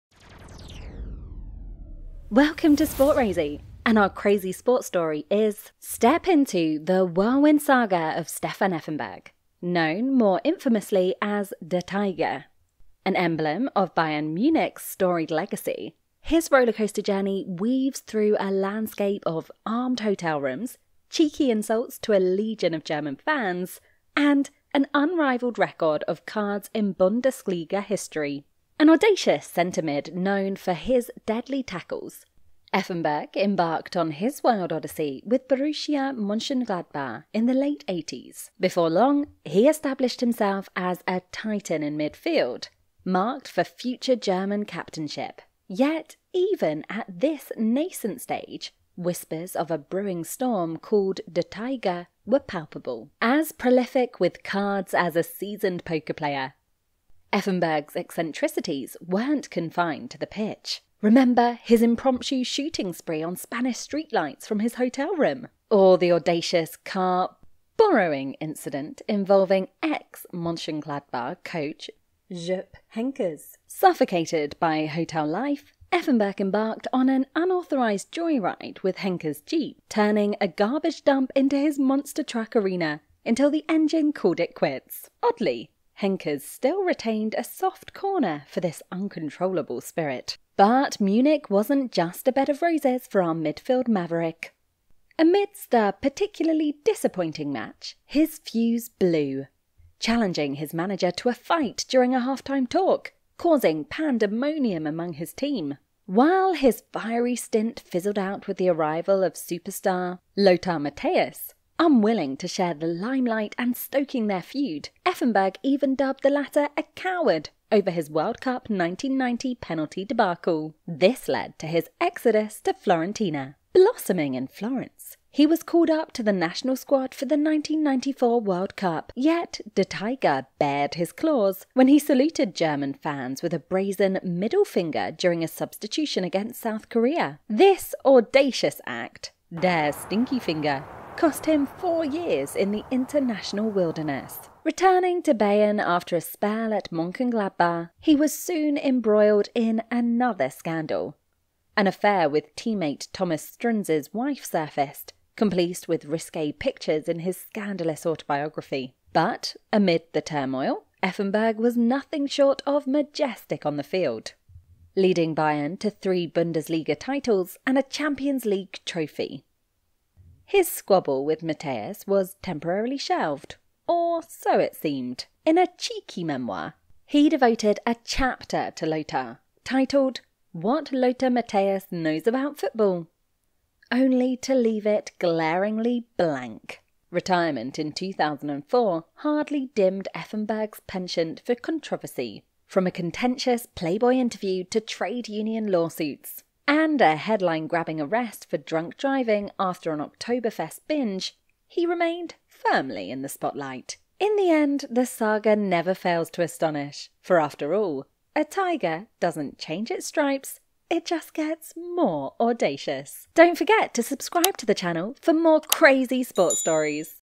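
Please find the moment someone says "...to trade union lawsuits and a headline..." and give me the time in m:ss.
3:14.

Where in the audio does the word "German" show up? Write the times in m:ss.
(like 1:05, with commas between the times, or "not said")
0:22, 0:44, 2:12.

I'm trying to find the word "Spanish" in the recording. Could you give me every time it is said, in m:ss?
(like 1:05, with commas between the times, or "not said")
1:03.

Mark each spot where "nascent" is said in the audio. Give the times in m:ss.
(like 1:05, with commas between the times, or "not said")
0:47.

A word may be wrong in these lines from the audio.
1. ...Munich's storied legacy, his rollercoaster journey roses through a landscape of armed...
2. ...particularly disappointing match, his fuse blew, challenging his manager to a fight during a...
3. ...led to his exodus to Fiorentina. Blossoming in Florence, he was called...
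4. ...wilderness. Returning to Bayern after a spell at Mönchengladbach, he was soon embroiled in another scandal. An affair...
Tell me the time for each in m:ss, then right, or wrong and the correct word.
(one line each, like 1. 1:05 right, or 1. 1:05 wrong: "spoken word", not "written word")
1. 0:14 wrong: "weaves", not "roses"
2. 1:35 right
3. 2:01 right
4. 2:23 right.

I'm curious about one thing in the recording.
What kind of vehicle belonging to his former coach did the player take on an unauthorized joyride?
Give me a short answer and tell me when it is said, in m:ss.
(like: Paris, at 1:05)
Jeep, at 1:19.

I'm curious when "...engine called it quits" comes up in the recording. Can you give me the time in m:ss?
1:23.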